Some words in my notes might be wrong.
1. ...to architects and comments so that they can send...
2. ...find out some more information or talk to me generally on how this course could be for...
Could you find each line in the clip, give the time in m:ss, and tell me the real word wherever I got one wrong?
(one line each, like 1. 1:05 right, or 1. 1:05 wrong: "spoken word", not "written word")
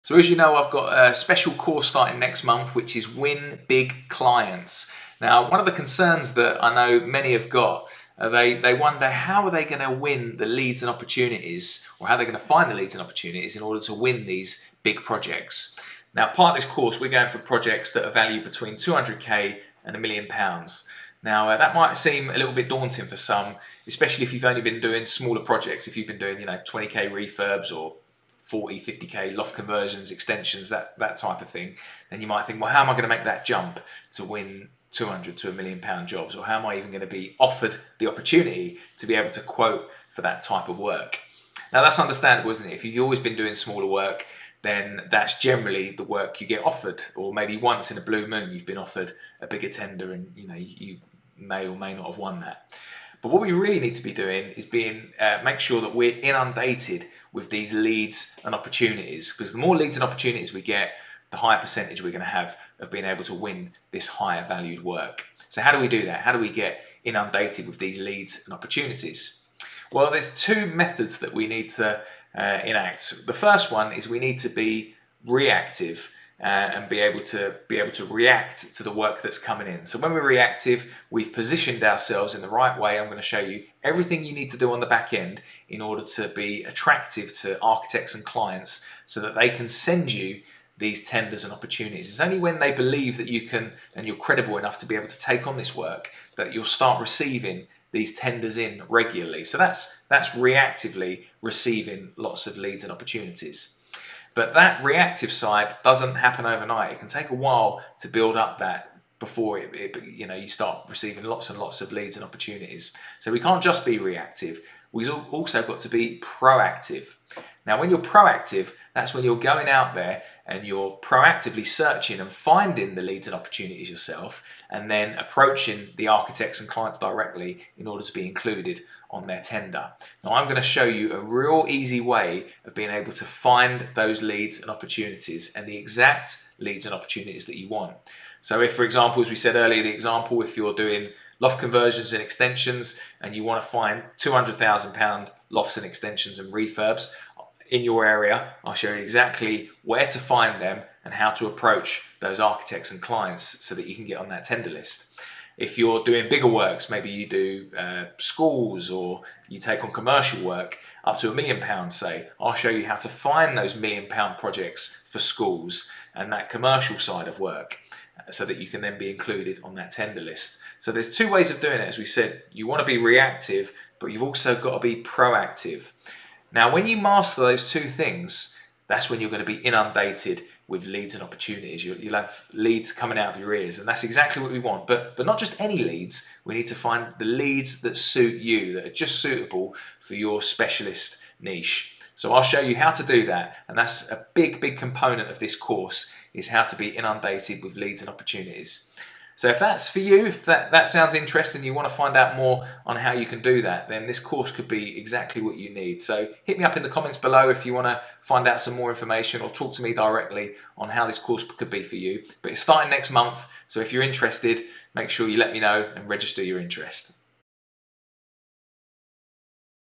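1. 1:27 wrong: "clients", not "comments"
2. 3:28 wrong: "directly", not "generally".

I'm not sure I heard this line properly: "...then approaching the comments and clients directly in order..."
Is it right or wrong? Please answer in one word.
wrong.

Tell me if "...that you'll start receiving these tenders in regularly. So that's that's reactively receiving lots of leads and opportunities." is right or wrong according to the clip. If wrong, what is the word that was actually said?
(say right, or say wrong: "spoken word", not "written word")
right.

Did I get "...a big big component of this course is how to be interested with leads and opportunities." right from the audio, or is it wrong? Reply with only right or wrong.
wrong.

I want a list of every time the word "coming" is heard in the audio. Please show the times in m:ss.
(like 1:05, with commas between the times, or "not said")
1:19, 3:02.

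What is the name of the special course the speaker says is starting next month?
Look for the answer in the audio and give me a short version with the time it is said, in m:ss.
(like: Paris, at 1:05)
Win Big Clients, at 0:03.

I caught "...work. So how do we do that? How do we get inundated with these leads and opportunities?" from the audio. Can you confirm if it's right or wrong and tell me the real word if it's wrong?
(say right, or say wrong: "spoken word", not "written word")
right.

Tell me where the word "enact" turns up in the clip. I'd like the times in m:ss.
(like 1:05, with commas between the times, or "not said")
1:12.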